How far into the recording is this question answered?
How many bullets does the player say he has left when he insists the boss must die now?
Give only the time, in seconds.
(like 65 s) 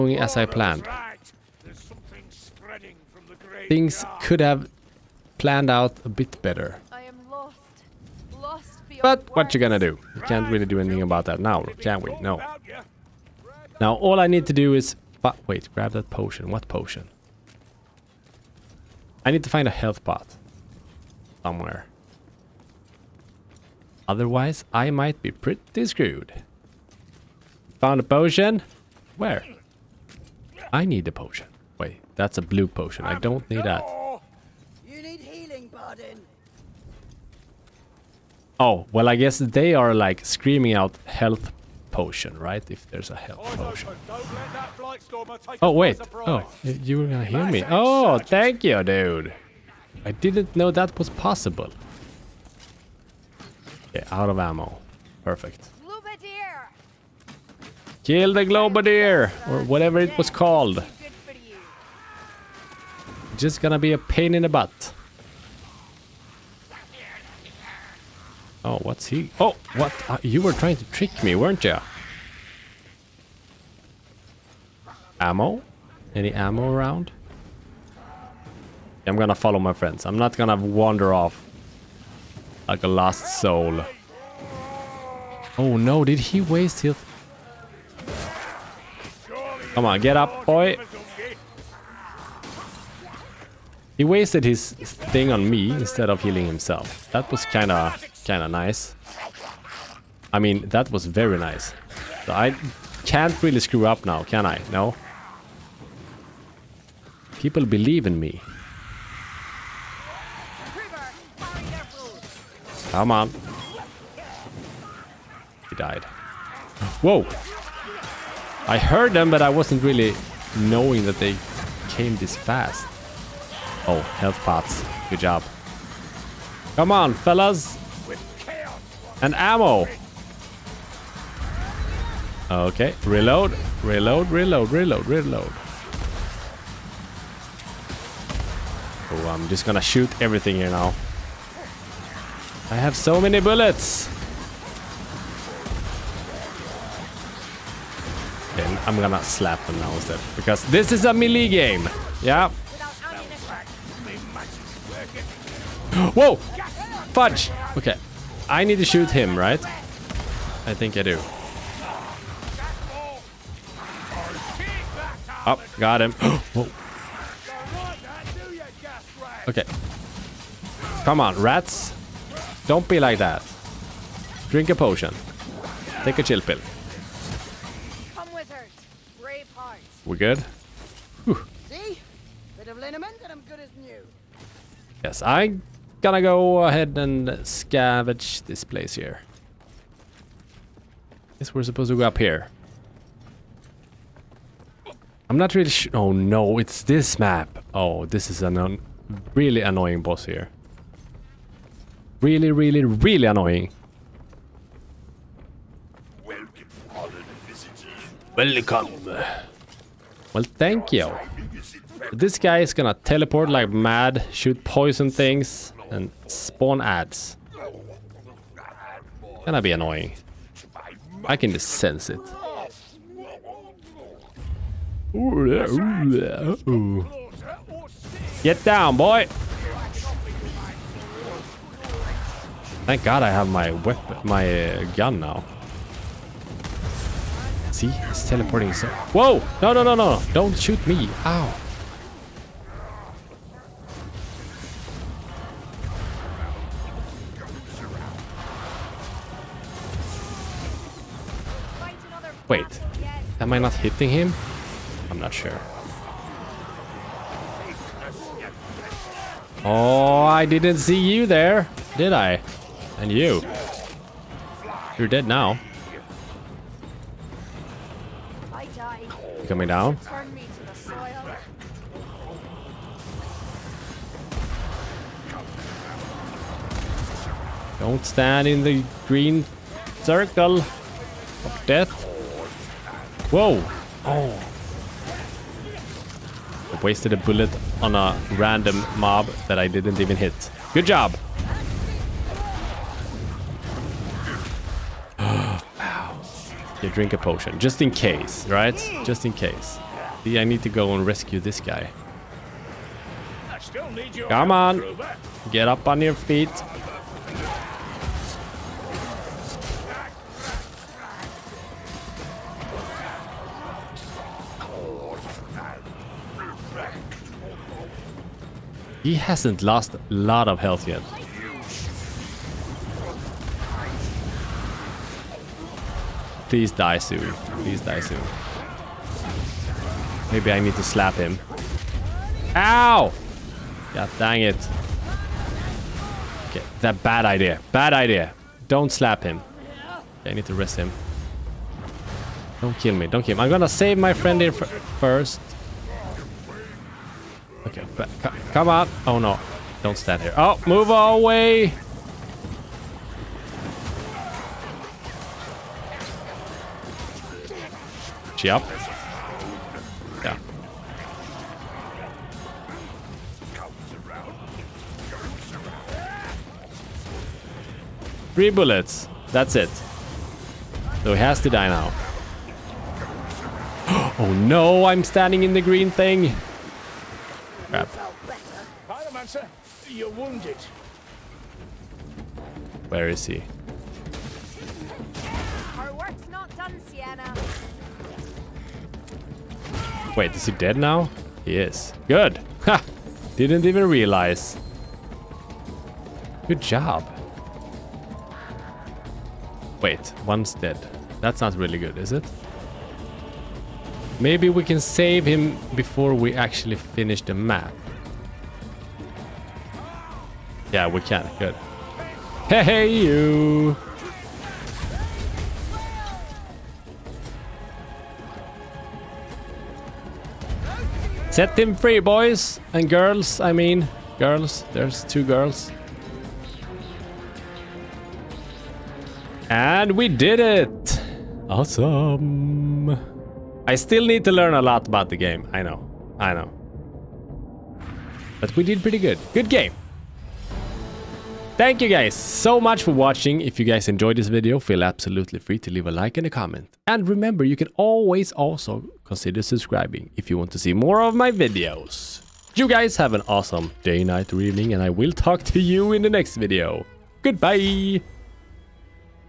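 368 s.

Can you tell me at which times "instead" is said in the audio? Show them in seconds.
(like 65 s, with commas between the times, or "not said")
95 s, 149 s.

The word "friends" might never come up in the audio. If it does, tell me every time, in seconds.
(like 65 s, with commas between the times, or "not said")
79 s, 344 s.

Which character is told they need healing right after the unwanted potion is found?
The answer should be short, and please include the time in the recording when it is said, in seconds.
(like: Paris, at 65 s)
Bardin, at 35 s.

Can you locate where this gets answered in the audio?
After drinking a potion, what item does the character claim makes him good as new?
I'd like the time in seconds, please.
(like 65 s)
182 s.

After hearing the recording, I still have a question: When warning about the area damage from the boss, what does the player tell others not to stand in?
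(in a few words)
Green circle of death.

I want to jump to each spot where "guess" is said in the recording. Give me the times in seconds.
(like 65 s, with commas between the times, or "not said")
39 s, 191 s.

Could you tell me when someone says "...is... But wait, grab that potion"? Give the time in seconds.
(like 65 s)
14 s.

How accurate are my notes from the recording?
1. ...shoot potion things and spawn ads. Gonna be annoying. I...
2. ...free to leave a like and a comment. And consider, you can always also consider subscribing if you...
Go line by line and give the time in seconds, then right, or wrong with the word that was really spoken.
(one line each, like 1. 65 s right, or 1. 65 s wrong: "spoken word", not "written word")
1. 214 s wrong: "poison", not "potion"
2. 445 s wrong: "remember", not "consider".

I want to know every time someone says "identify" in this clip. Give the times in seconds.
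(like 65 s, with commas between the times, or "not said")
not said.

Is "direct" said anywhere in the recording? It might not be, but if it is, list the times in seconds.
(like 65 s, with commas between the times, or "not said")
not said.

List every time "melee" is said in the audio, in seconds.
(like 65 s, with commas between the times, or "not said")
151 s.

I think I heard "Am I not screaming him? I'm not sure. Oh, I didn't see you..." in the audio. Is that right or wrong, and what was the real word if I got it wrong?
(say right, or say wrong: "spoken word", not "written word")
wrong: "hitting", not "screaming".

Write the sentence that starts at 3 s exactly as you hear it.
Things could have planned out a bit better.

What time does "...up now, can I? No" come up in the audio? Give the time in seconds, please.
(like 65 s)
103 s.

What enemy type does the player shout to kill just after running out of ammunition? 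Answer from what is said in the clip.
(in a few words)
Globadier.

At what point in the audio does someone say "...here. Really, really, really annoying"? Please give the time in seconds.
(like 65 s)
200 s.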